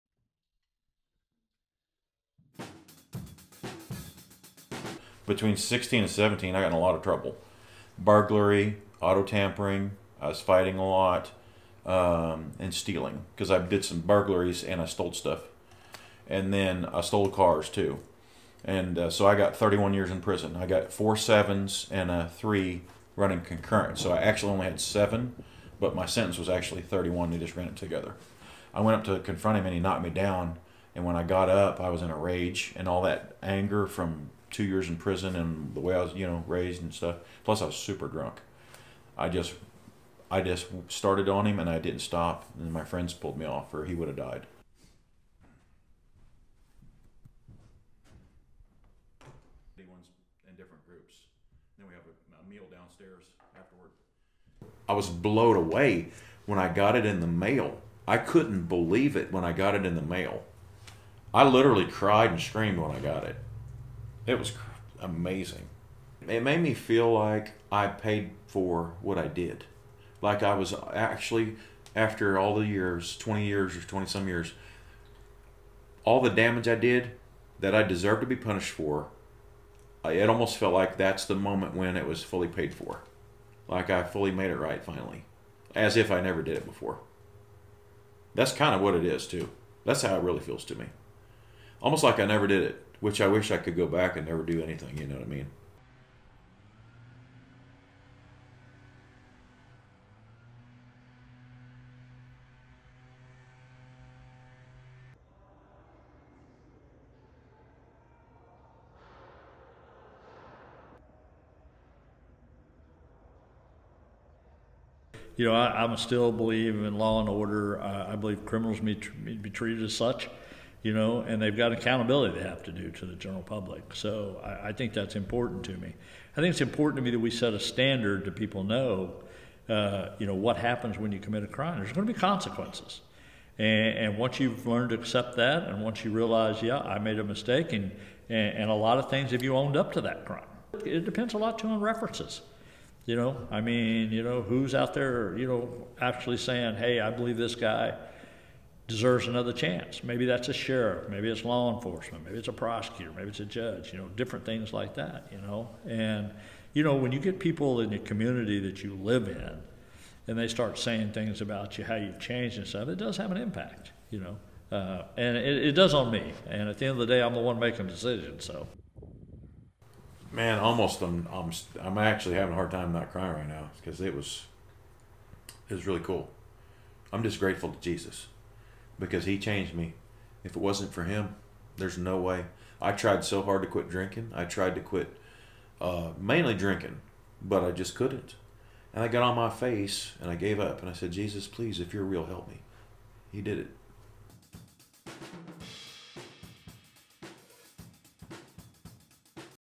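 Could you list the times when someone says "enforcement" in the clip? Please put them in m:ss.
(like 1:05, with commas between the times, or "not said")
2:31.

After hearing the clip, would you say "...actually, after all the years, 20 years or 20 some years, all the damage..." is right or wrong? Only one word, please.
right.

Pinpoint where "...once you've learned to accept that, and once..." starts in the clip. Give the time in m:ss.
2:14.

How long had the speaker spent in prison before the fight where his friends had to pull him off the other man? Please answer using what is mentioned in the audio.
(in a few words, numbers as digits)
2 years.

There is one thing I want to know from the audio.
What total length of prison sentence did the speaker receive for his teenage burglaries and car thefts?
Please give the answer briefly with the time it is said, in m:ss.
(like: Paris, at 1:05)
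31 years, at 0:19.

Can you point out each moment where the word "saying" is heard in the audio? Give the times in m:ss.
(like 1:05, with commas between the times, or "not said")
2:26, 2:40.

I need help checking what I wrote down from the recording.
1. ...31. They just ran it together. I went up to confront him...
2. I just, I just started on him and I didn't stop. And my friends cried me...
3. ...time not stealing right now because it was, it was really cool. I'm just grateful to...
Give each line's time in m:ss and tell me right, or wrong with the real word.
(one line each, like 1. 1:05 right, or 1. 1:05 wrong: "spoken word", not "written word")
1. 0:26 right
2. 0:39 wrong: "pulled", not "cried"
3. 2:52 wrong: "crying", not "stealing".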